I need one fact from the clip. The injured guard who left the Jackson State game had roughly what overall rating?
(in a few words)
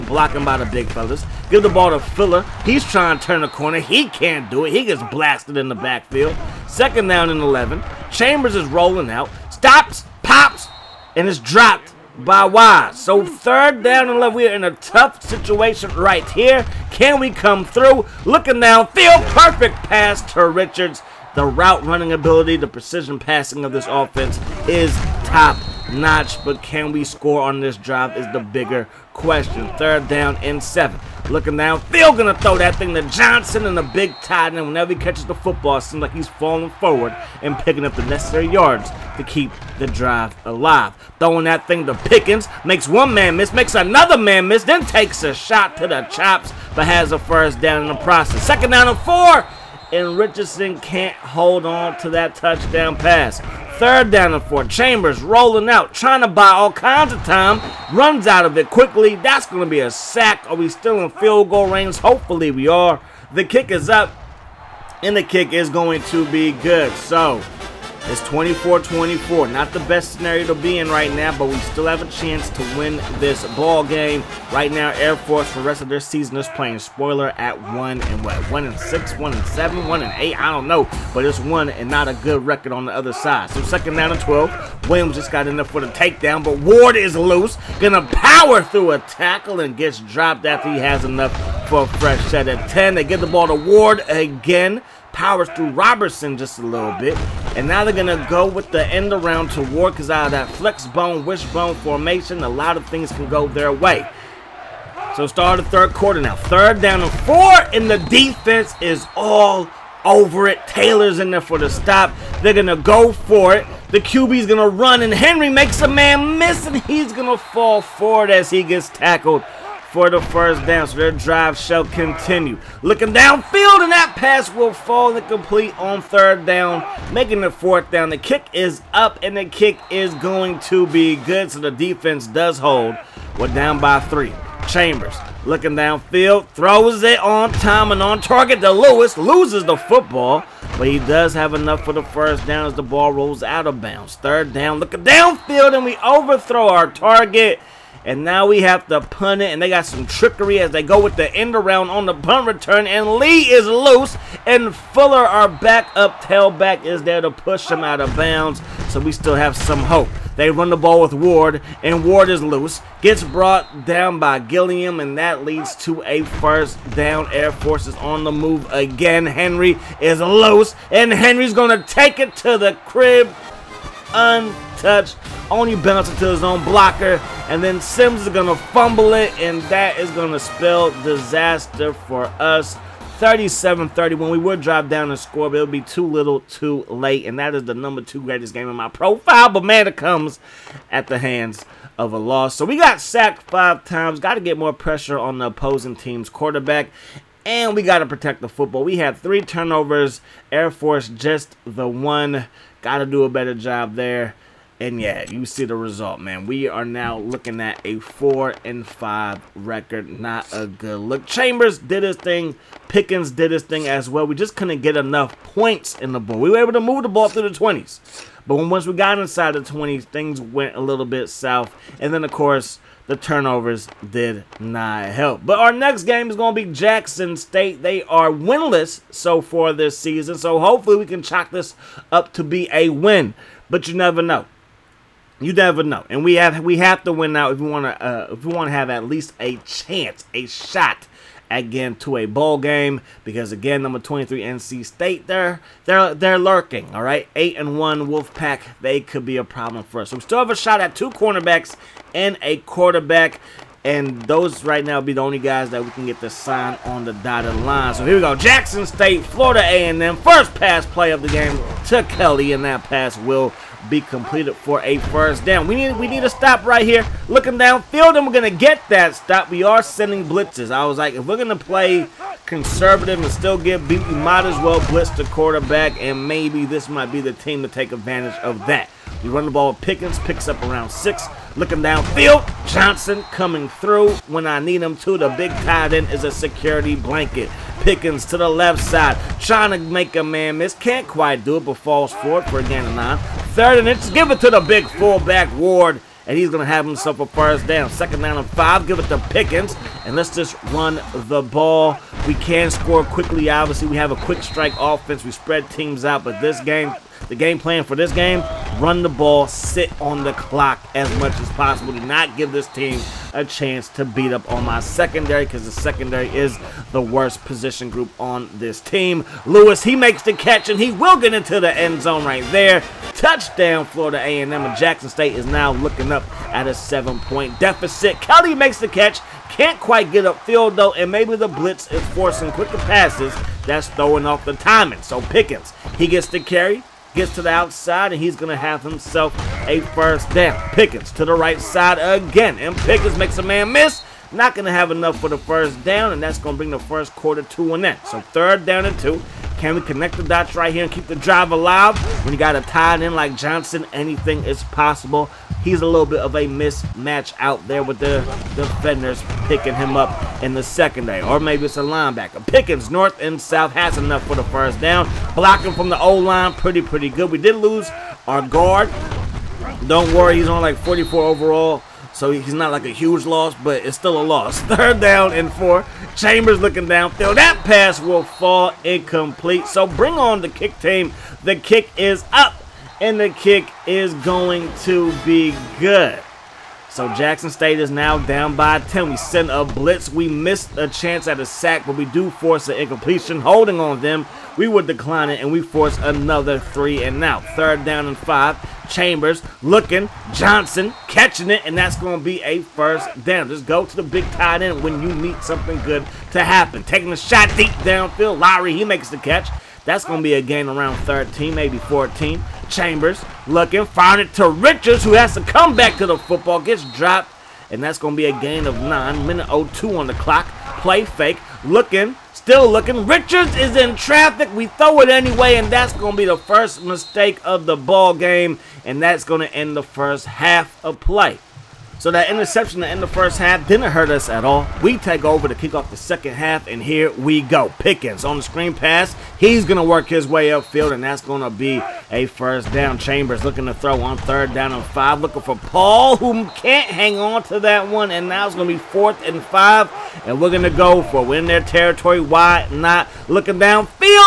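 44.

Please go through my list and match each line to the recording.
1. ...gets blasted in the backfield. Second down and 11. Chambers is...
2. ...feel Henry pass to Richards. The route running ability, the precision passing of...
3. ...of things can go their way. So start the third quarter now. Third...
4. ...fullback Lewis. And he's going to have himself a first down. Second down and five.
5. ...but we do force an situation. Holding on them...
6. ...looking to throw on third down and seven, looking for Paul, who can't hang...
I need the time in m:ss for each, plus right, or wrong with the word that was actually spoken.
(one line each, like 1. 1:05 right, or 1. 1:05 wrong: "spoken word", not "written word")
1. 0:04 right
2. 0:18 wrong: "Perfect", not "Henry"
3. 1:42 right
4. 4:54 wrong: "Ward", not "Lewis"
5. 6:31 wrong: "incompletion", not "situation"
6. 7:23 wrong: "five", not "seven".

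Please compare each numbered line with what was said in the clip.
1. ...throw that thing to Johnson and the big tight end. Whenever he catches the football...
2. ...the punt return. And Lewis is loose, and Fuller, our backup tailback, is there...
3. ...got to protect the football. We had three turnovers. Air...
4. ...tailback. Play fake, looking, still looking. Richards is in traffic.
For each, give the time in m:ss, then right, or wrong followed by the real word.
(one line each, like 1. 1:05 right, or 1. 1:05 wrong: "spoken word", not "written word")
1. 0:32 right
2. 2:32 wrong: "Lee", not "Lewis"
3. 3:17 right
4. 7:00 wrong: "clock", not "tailback".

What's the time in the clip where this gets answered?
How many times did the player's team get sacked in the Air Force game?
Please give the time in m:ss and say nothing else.
3:13.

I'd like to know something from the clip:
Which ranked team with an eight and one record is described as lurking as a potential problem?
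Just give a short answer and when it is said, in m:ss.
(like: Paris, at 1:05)
NC State, at 4:04.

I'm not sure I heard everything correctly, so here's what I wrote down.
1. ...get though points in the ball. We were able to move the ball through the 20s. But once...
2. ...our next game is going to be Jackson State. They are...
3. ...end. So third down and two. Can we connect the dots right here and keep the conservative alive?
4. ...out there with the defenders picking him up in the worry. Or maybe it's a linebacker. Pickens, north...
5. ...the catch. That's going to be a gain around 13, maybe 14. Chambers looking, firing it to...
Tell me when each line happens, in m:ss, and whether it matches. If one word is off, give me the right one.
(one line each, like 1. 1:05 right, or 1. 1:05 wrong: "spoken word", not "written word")
1. 3:34 wrong: "enough", not "though"
2. 3:45 right
3. 5:47 wrong: "drive", not "conservative"
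4. 5:57 wrong: "secondary", not "worry"
5. 6:49 right.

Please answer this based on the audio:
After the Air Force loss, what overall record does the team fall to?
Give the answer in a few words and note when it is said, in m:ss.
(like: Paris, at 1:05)
4 and 5, at 3:27.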